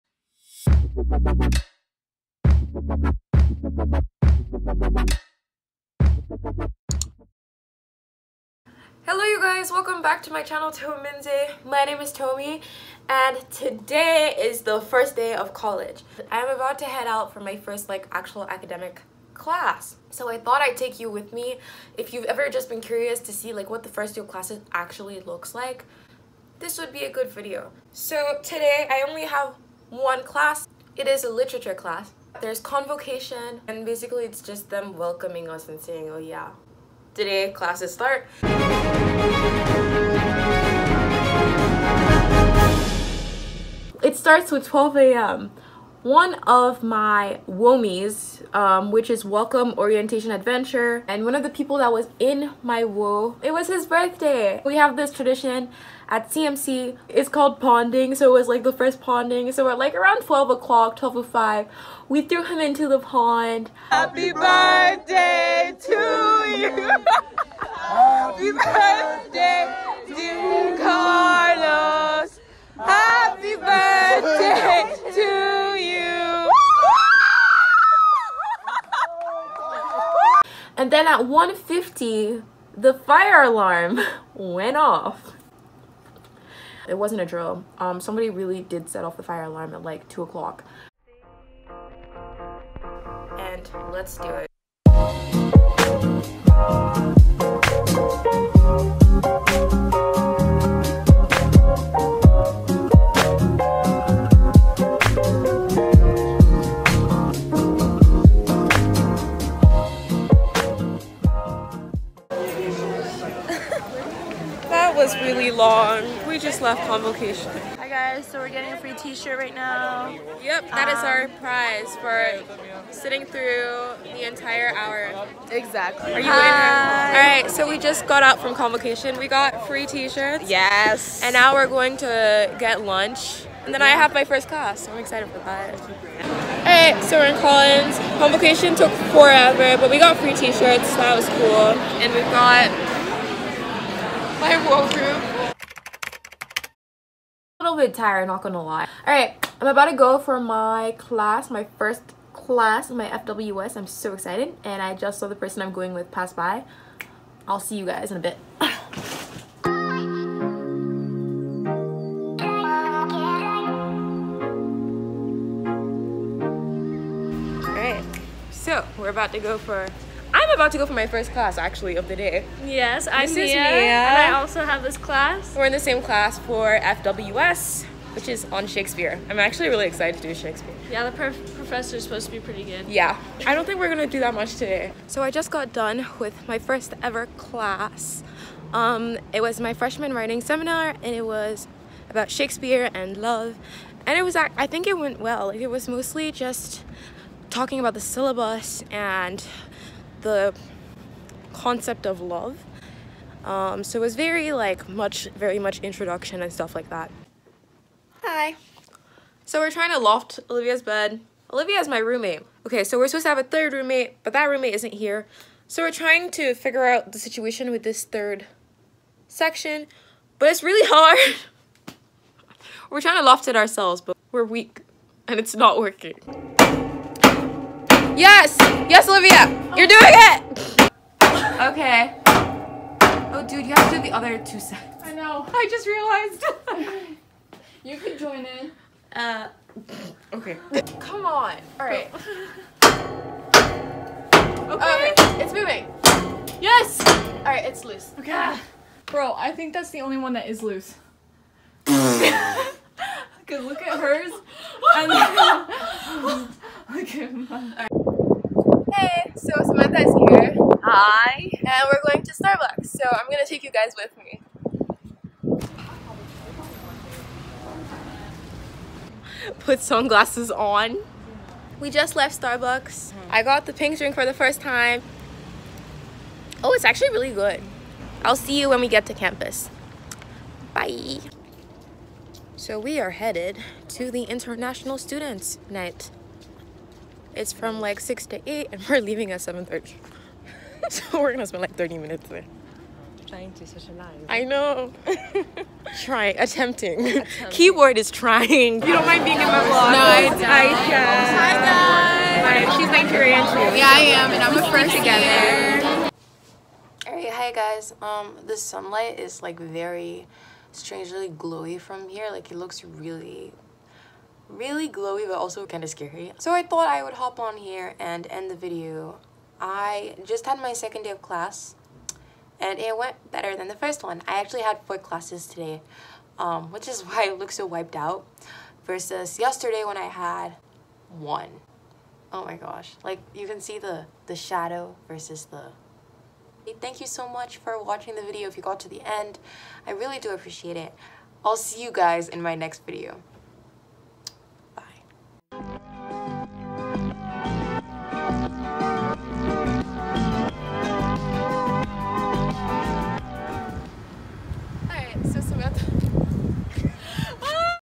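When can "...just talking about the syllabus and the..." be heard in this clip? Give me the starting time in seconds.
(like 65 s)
196 s.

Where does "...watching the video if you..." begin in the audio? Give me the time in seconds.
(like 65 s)
337 s.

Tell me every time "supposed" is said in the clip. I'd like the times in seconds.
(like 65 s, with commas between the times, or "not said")
182 s, 213 s.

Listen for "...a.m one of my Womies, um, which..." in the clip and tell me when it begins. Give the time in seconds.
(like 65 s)
44 s.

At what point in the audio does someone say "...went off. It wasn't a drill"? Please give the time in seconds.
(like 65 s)
84 s.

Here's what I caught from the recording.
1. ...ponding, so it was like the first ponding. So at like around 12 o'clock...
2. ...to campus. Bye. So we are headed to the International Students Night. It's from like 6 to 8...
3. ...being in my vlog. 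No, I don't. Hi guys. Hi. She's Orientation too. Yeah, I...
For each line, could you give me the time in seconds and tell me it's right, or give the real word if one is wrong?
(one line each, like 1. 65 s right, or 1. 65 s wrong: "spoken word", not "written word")
1. 57 s right
2. 279 s right
3. 299 s wrong: "Nigerian", not "Orientation".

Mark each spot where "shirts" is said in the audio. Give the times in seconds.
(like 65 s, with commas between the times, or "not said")
118 s, 129 s, 140 s.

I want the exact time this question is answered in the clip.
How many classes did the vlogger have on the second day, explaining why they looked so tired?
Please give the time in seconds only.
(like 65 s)
324 s.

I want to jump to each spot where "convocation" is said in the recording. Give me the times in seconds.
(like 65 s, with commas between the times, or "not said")
32 s, 116 s, 128 s, 138 s.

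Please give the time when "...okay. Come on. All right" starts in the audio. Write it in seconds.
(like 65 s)
240 s.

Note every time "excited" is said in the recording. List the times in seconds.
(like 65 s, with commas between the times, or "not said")
134 s, 154 s, 179 s.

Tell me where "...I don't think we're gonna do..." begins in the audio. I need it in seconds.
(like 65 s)
183 s.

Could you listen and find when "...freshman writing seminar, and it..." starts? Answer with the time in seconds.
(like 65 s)
189 s.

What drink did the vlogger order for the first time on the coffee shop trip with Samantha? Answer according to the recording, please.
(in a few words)
pink drink.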